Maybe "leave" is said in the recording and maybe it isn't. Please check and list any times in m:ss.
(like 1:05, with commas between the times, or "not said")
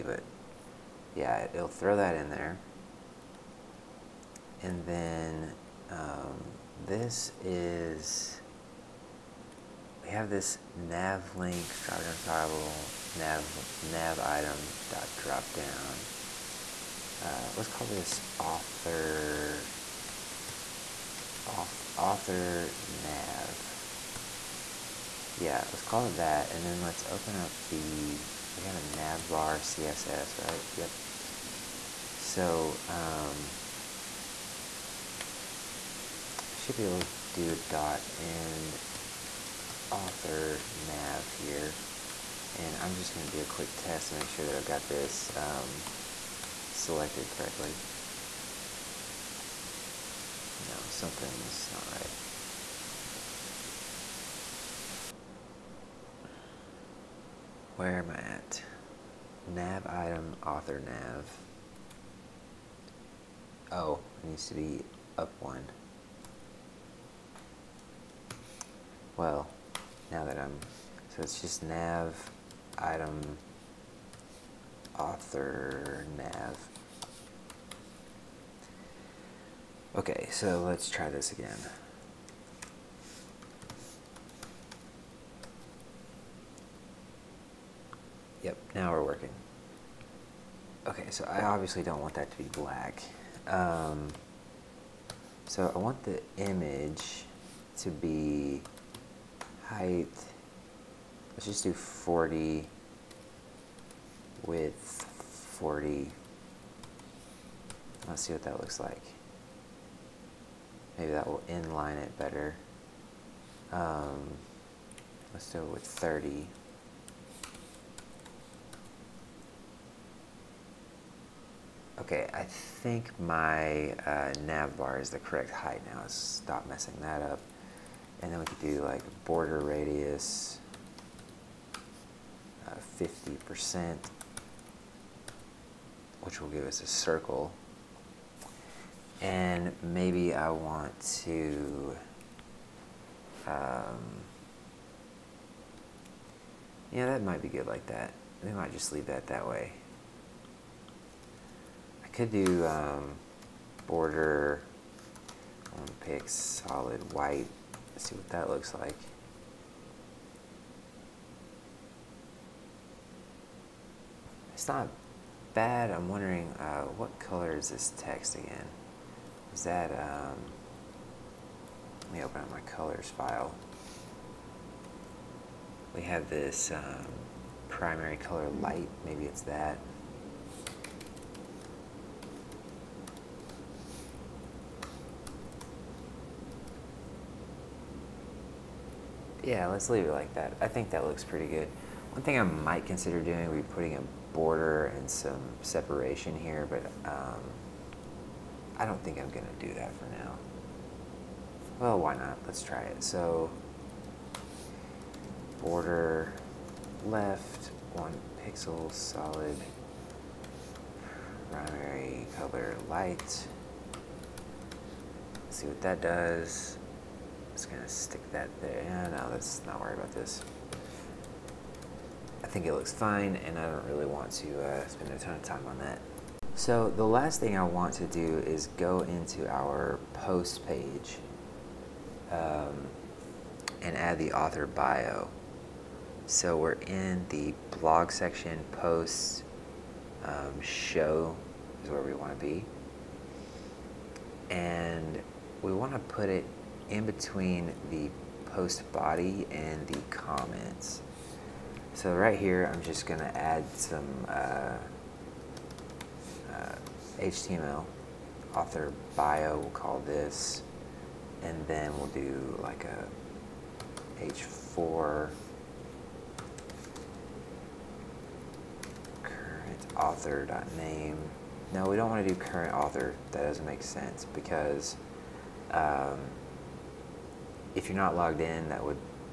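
2:28, 3:09.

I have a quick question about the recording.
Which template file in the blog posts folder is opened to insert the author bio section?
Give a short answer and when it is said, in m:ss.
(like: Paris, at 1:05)
show, at 4:00.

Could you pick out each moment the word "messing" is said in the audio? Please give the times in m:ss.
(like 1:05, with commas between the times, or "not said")
2:06.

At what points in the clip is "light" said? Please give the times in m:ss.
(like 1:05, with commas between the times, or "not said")
2:58, 3:32.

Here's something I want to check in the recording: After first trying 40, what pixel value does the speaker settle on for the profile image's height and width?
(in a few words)
30.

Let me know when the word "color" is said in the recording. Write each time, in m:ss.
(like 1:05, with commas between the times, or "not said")
2:47, 2:52, 2:58, 3:32.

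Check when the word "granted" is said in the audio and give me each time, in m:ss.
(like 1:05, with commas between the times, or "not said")
not said.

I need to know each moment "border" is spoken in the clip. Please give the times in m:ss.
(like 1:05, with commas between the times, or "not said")
2:09, 2:33, 3:14, 3:25.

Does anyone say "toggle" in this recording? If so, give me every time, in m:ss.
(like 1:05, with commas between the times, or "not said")
0:12.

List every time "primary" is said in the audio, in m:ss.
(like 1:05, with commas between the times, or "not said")
2:57, 3:31.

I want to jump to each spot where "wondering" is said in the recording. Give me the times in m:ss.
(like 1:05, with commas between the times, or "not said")
2:46.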